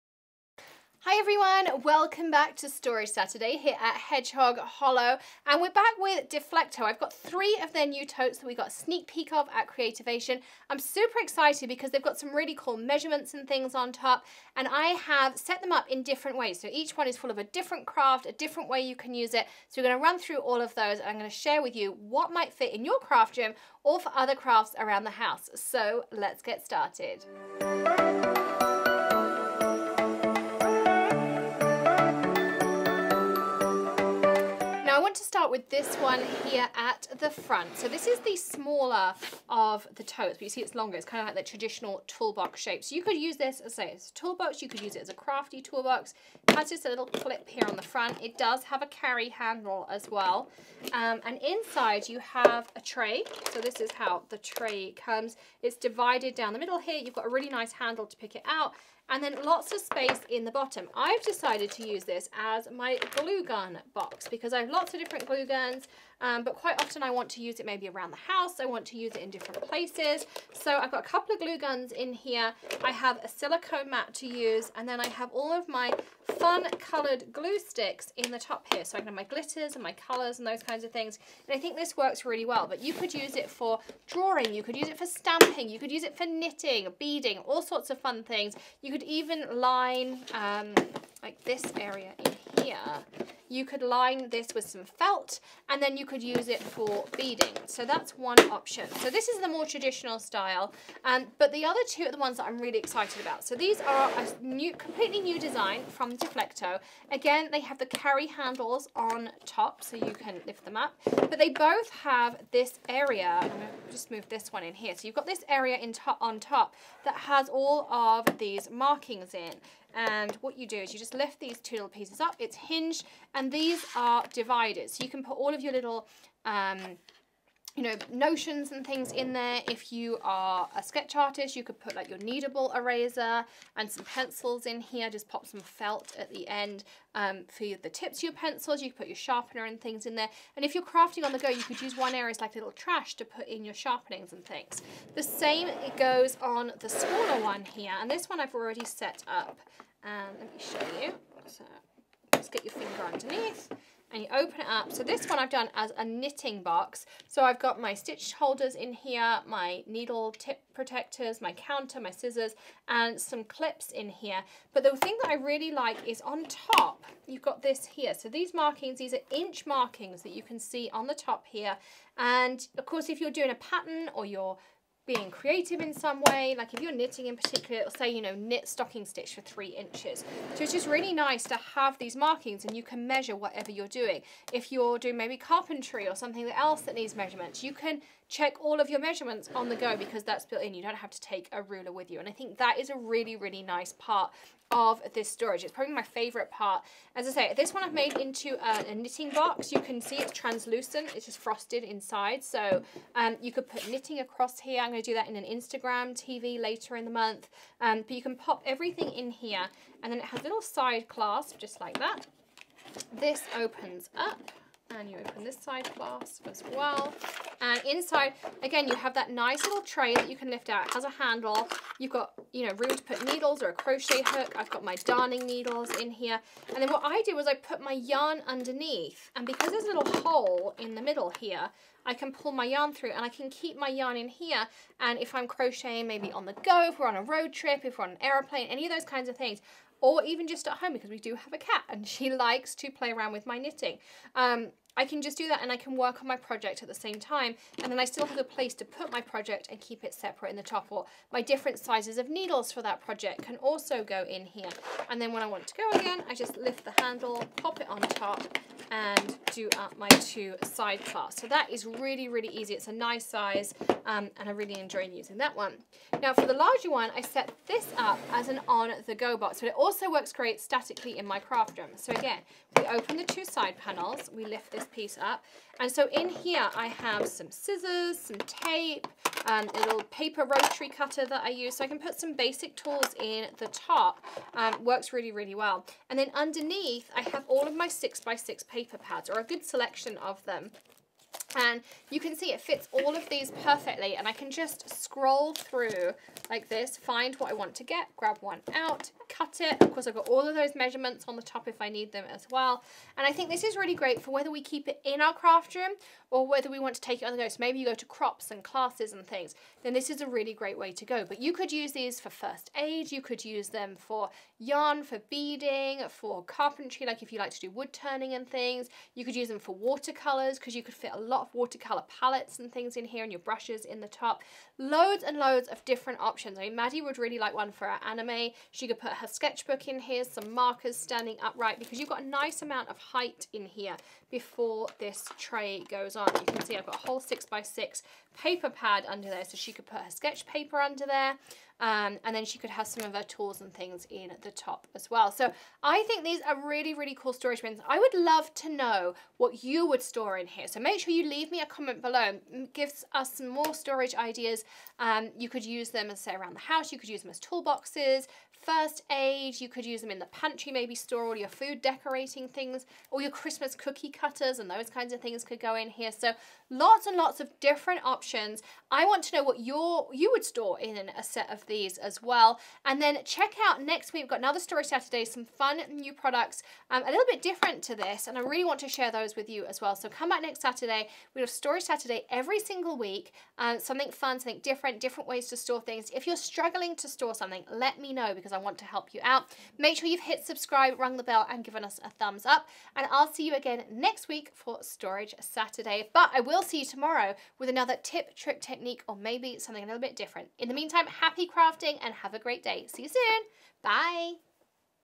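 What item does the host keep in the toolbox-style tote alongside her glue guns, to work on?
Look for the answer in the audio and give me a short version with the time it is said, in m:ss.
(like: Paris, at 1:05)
silicone mat, at 1:13.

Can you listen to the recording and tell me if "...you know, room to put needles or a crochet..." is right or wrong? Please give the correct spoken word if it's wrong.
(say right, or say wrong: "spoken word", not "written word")
right.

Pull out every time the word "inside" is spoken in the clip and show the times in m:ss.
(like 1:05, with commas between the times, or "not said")
0:51, 3:21, 3:37.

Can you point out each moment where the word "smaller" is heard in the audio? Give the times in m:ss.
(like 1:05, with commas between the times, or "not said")
0:38, 2:26.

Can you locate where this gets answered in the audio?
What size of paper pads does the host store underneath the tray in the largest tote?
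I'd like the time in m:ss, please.
4:47.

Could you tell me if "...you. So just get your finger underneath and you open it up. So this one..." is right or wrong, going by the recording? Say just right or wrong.
right.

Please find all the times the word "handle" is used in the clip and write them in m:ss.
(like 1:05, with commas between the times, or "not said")
0:49, 0:57, 1:48, 3:41, 4:17.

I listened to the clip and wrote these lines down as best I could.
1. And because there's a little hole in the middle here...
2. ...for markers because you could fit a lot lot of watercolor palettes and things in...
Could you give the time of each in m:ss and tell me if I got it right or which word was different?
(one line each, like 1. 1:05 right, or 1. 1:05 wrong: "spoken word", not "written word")
1. 3:49 right
2. 5:19 wrong: "watercolors", not "markers".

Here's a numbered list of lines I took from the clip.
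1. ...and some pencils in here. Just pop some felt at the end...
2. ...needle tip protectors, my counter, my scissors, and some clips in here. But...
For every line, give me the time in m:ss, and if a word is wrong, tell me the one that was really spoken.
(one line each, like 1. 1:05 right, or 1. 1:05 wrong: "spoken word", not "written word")
1. 2:13 right
2. 2:39 right.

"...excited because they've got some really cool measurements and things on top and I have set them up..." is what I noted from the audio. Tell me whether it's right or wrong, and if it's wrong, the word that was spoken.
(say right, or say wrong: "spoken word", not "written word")
right.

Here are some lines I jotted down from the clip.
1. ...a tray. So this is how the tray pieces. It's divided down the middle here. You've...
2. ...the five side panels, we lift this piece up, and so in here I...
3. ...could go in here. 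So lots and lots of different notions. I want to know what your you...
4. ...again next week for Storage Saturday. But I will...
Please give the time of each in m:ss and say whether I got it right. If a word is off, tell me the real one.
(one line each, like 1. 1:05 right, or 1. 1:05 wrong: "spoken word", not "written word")
1. 0:52 wrong: "comes", not "pieces"
2. 4:33 wrong: "two", not "five"
3. 6:05 wrong: "options", not "notions"
4. 6:33 right.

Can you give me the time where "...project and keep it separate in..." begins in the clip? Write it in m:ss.
4:09.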